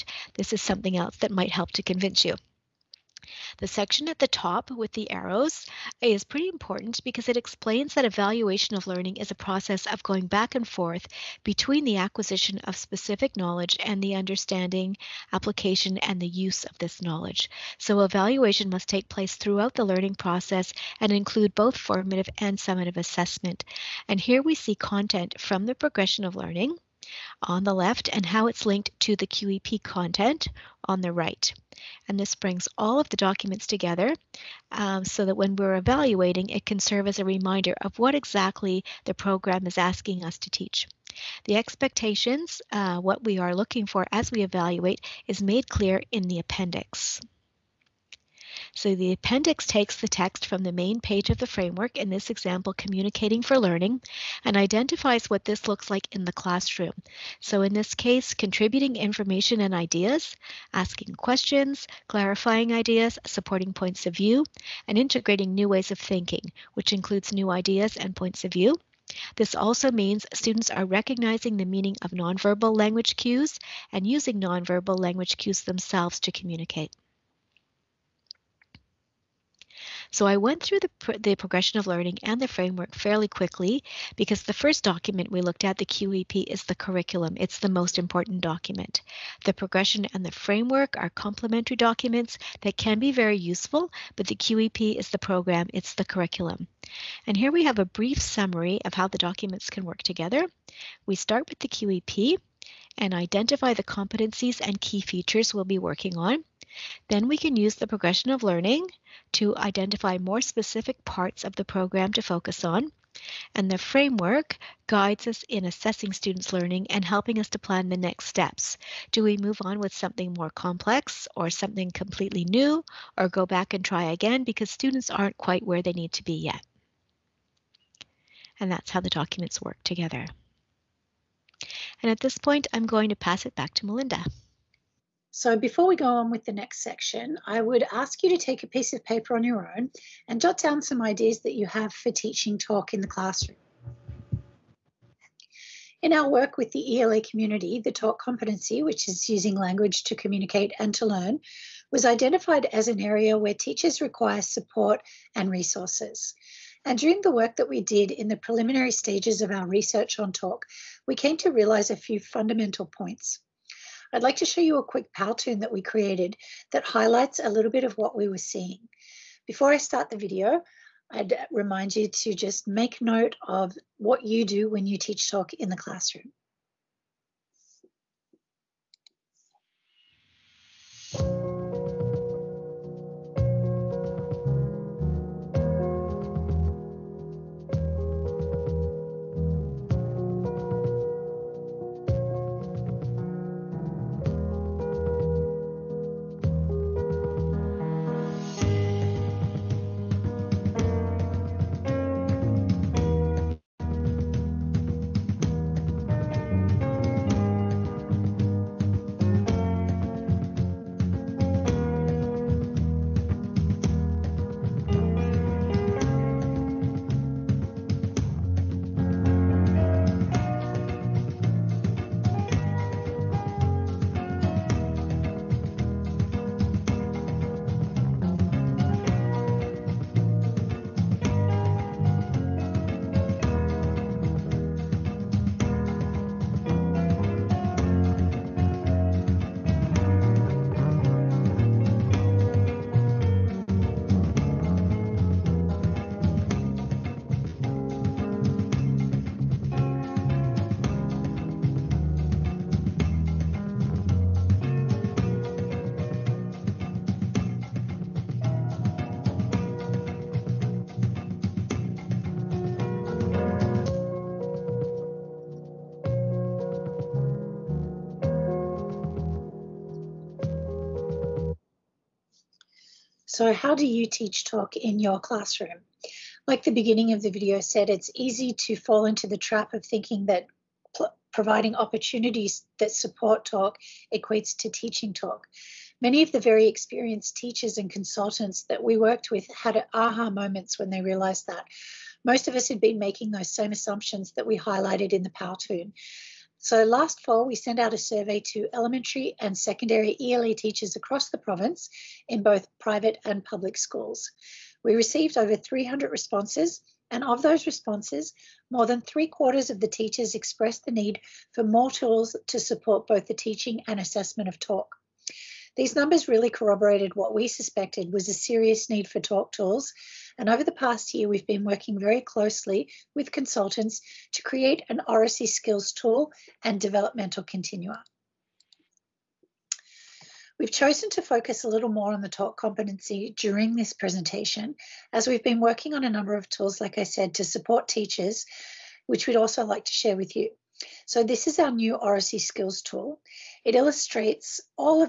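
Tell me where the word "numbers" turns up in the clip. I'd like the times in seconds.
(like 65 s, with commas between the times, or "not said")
315 s, 336 s.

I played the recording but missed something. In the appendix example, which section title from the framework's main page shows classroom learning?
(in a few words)
Communicating for Learning.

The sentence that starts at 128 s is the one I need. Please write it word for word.
And that's how the documents work together.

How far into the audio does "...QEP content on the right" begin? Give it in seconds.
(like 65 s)
29 s.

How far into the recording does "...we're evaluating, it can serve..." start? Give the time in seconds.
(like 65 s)
35 s.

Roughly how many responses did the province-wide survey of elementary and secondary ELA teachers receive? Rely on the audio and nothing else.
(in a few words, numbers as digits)
Over 300.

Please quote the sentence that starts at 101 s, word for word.
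We start with the QEP, and identify the competencies and key features we'll be working on.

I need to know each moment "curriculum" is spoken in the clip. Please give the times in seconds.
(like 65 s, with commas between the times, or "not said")
86 s, 96 s.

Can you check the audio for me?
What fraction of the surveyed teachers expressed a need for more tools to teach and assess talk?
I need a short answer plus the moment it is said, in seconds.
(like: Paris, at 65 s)
More than three quarters, at 308 s.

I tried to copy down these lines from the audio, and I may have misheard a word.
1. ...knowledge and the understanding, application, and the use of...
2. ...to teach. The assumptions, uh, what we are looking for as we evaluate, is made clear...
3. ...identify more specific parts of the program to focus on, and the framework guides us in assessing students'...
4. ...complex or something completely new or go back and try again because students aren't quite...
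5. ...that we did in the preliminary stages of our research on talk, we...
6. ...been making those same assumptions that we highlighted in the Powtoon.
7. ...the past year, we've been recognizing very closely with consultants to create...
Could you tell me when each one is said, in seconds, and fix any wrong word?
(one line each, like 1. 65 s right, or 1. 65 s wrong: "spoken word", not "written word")
1. 13 s right
2. 40 s wrong: "expectations", not "assumptions"
3. 109 s right
4. 120 s right
5. 157 s right
6. 292 s right
7. 320 s wrong: "working", not "recognizing".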